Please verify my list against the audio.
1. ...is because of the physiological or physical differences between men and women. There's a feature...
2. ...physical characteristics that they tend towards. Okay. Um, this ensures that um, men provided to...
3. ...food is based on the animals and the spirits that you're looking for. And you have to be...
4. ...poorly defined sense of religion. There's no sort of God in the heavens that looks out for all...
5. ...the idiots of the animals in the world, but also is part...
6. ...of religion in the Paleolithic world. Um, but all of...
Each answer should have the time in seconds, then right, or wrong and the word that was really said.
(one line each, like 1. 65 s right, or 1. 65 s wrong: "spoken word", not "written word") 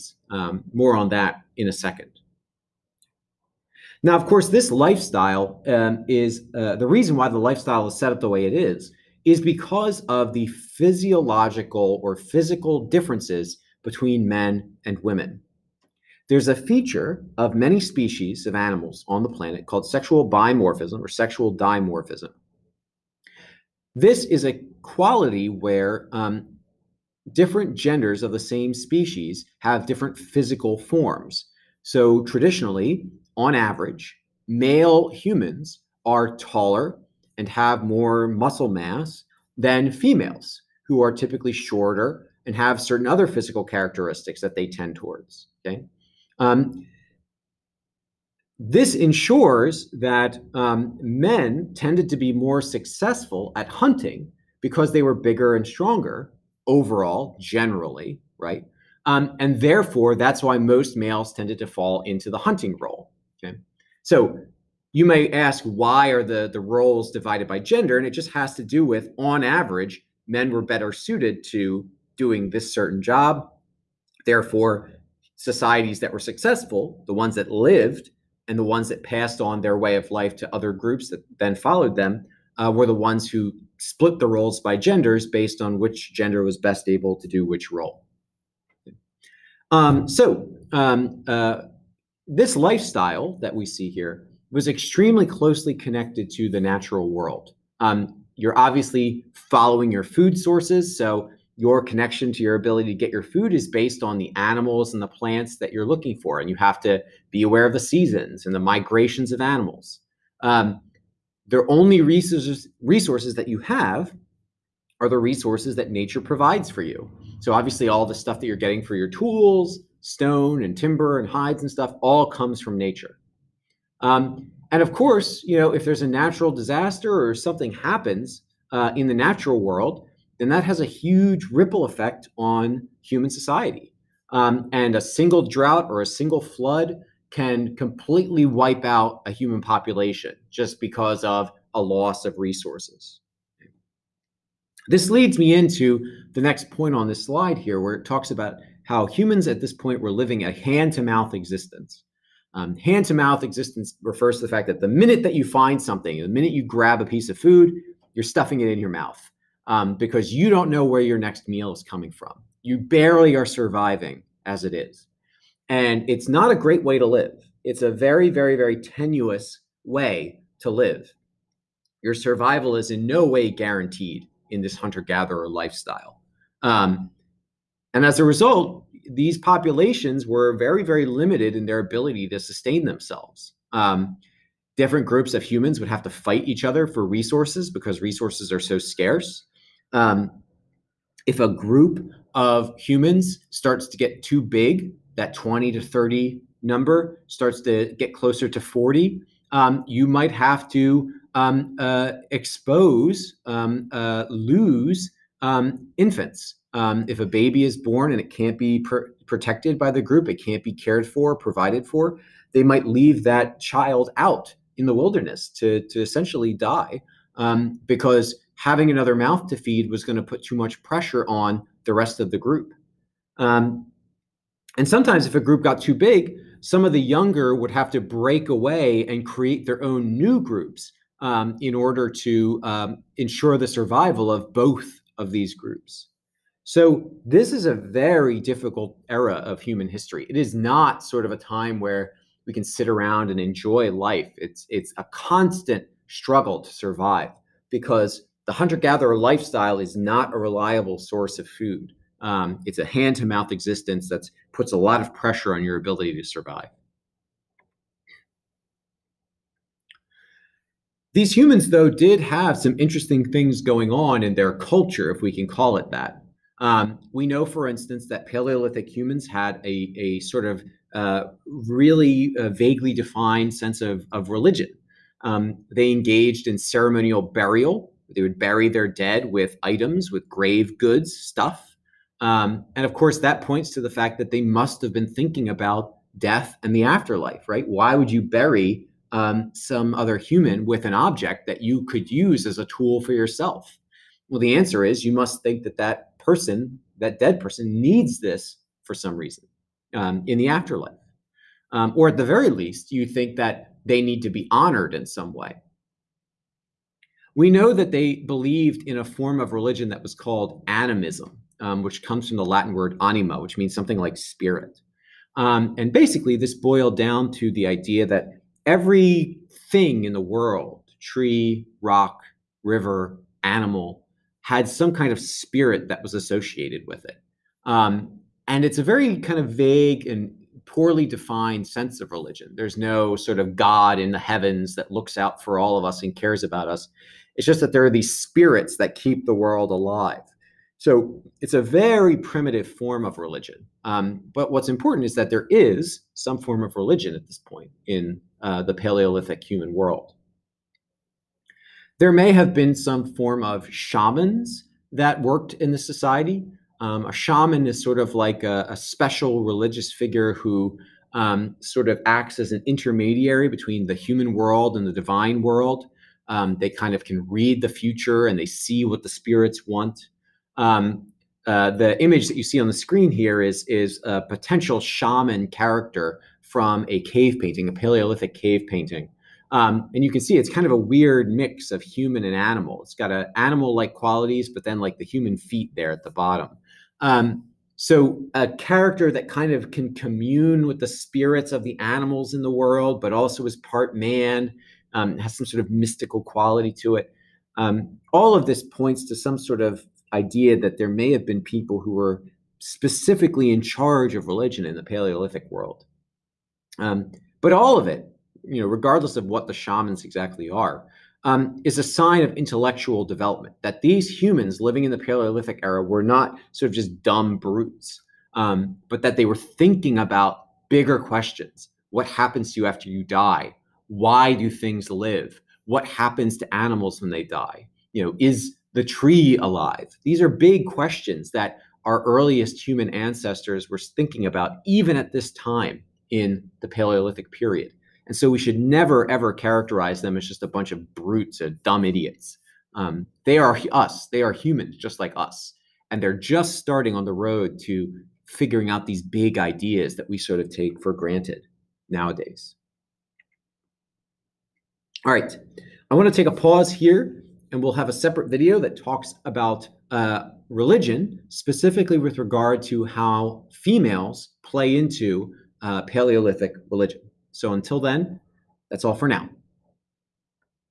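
1. 9 s right
2. 43 s wrong: "tended", not "provided"
3. 103 s wrong: "plants", not "spirits"
4. 330 s right
5. 390 s wrong: "spirits", not "idiots"
6. 404 s right.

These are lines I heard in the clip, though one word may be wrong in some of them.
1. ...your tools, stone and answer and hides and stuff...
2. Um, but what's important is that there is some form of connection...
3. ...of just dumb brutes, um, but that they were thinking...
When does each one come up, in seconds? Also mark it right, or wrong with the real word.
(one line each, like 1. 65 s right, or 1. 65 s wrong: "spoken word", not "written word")
1. 118 s wrong: "timber", not "answer"
2. 343 s wrong: "religion", not "connection"
3. 416 s right.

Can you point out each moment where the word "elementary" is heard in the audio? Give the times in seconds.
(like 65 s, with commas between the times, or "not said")
not said.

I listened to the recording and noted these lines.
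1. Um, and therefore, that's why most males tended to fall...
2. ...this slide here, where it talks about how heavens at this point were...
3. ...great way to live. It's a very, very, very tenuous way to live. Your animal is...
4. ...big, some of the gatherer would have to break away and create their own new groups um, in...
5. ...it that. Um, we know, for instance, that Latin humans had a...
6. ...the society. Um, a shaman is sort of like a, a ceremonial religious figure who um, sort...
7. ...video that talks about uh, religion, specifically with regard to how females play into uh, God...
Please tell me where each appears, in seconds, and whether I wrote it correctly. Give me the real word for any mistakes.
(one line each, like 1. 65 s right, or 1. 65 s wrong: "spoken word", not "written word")
1. 59 s right
2. 147 s wrong: "humans", not "heavens"
3. 166 s wrong: "survival", not "animal"
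4. 225 s wrong: "younger", not "gatherer"
5. 265 s wrong: "Paleolithic", not "Latin"
6. 355 s wrong: "special", not "ceremonial"
7. 458 s wrong: "Paleolithic", not "God".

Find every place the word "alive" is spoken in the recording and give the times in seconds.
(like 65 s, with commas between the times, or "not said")
339 s, 429 s.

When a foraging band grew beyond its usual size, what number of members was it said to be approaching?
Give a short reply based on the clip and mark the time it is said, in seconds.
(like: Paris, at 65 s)
40, at 198 s.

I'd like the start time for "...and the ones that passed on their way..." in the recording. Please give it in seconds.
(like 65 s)
78 s.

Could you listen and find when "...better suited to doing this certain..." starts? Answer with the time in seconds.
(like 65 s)
70 s.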